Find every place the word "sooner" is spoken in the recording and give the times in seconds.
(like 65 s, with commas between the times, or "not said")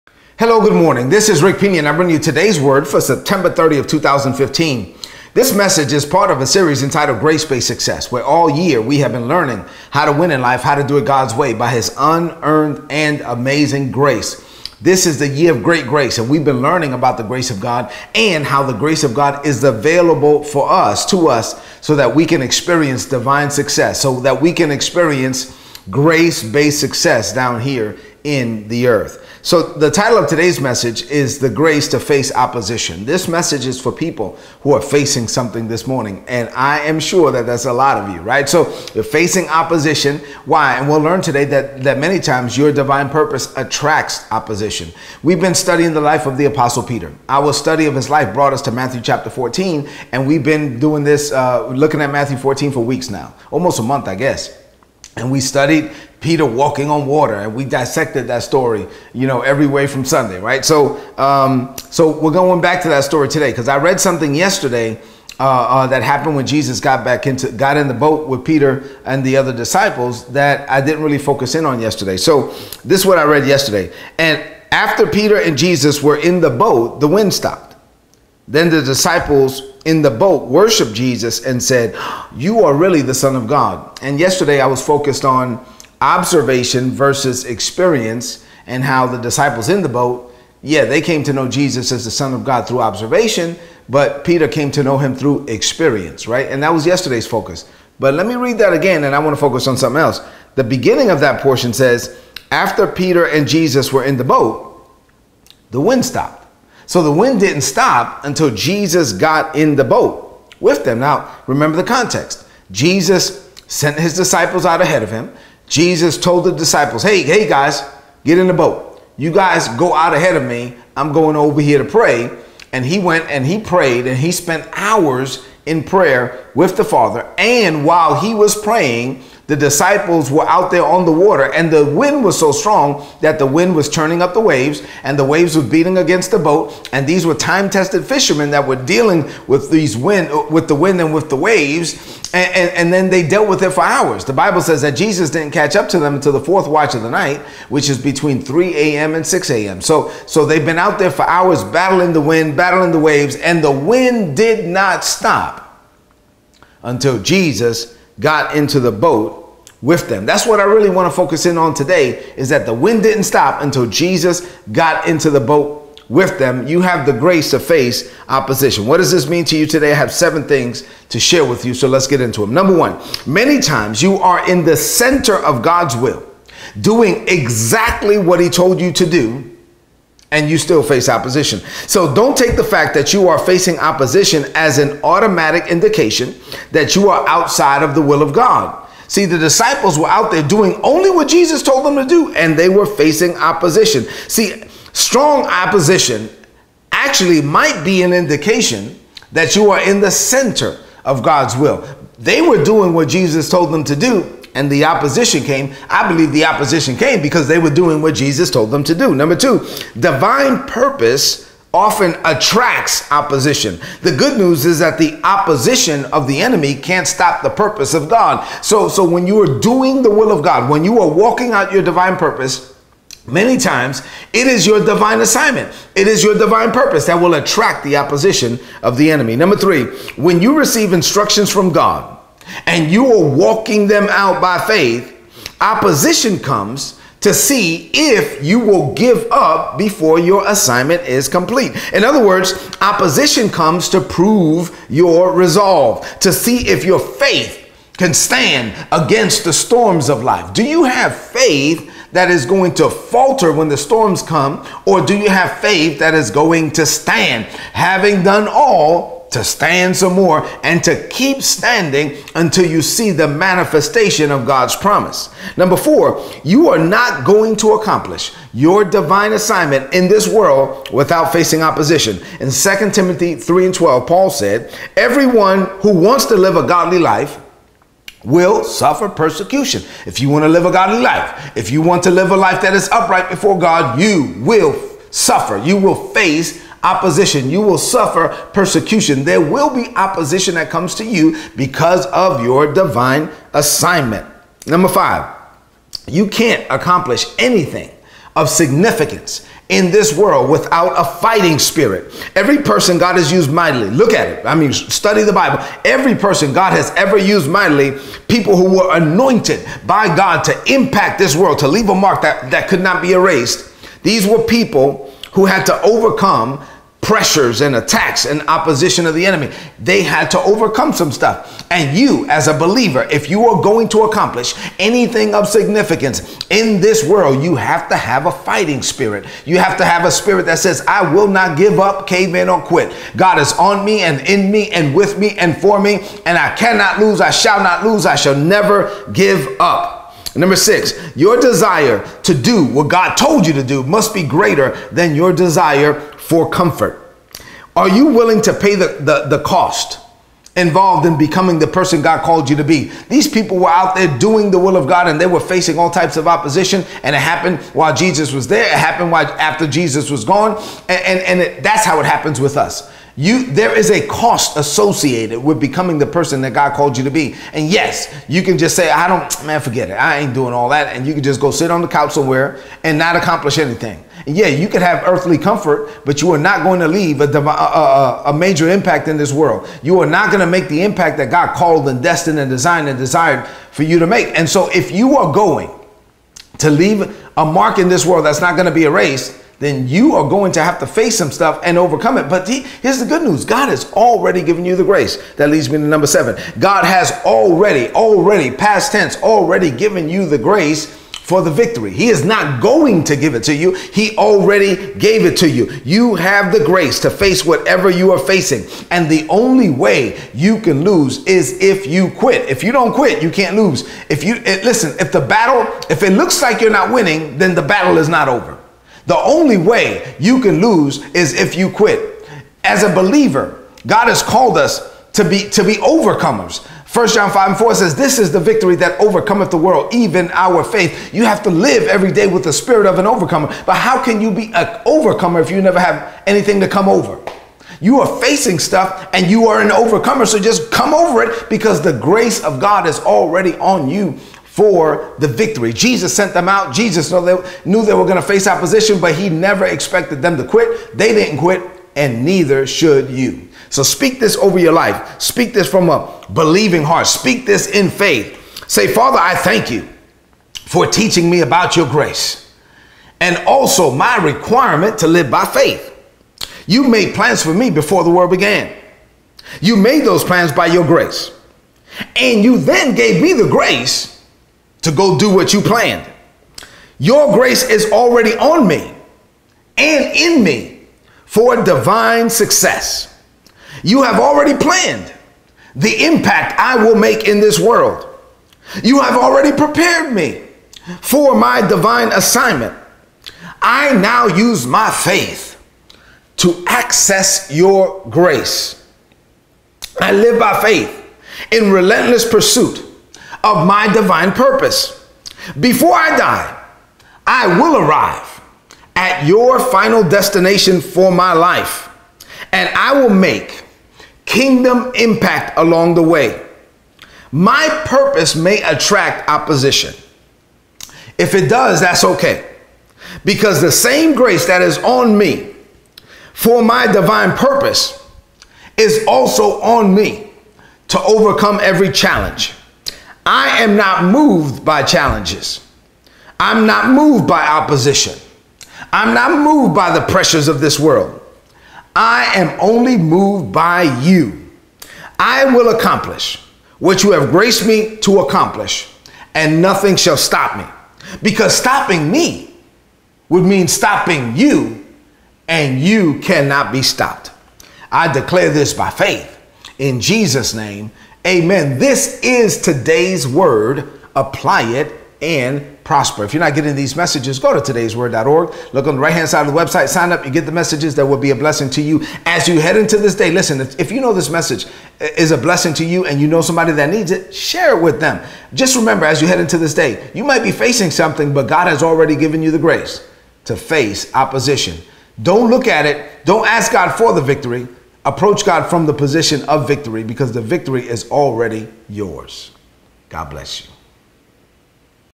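not said.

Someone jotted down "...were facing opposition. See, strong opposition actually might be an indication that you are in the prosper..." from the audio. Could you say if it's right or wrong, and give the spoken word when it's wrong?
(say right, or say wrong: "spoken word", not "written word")
wrong: "center", not "prosper".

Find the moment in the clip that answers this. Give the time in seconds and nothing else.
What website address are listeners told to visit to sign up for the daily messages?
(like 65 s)
567 s.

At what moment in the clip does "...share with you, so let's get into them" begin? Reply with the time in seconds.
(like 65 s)
171 s.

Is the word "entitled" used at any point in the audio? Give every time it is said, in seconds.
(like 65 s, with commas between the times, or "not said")
6 s.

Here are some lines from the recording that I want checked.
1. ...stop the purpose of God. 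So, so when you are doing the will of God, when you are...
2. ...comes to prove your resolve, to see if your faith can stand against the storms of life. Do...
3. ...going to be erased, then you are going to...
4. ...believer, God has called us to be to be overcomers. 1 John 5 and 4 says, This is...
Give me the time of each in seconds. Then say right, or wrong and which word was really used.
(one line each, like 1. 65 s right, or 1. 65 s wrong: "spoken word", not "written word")
1. 217 s right
2. 243 s right
3. 388 s right
4. 422 s right.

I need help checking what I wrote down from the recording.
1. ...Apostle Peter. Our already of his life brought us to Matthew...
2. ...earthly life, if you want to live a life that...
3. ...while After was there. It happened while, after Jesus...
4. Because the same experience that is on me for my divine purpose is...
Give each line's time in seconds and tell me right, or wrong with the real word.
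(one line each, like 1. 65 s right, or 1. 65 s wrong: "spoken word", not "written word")
1. 46 s wrong: "study", not "already"
2. 280 s wrong: "godly", not "earthly"
3. 357 s wrong: "Jesus", not "After"
4. 523 s wrong: "grace", not "experience".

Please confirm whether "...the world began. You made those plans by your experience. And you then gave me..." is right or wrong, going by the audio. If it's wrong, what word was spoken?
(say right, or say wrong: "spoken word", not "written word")
wrong: "grace", not "experience".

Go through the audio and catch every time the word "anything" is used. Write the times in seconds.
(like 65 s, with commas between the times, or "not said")
297 s, 324 s, 373 s, 436 s.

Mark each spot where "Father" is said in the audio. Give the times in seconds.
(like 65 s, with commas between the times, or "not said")
126 s, 458 s.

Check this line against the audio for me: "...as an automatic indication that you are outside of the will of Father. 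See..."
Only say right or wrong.
wrong.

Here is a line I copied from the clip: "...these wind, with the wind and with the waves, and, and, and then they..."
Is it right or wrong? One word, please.
right.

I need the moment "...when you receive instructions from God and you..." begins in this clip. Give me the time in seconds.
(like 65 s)
230 s.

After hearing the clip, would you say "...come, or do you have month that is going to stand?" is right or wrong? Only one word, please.
wrong.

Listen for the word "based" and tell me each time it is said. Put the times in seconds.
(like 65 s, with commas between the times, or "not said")
7 s, 26 s.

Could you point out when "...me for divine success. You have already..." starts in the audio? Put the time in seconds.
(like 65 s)
480 s.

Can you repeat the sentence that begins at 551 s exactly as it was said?
Because stopping me would mean stopping you, and you cannot be stopped.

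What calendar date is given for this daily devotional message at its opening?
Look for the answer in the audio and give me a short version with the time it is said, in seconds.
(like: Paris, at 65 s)
September 30th, 2015, at 2 s.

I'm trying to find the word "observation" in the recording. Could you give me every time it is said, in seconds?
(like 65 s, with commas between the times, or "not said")
86 s, 92 s.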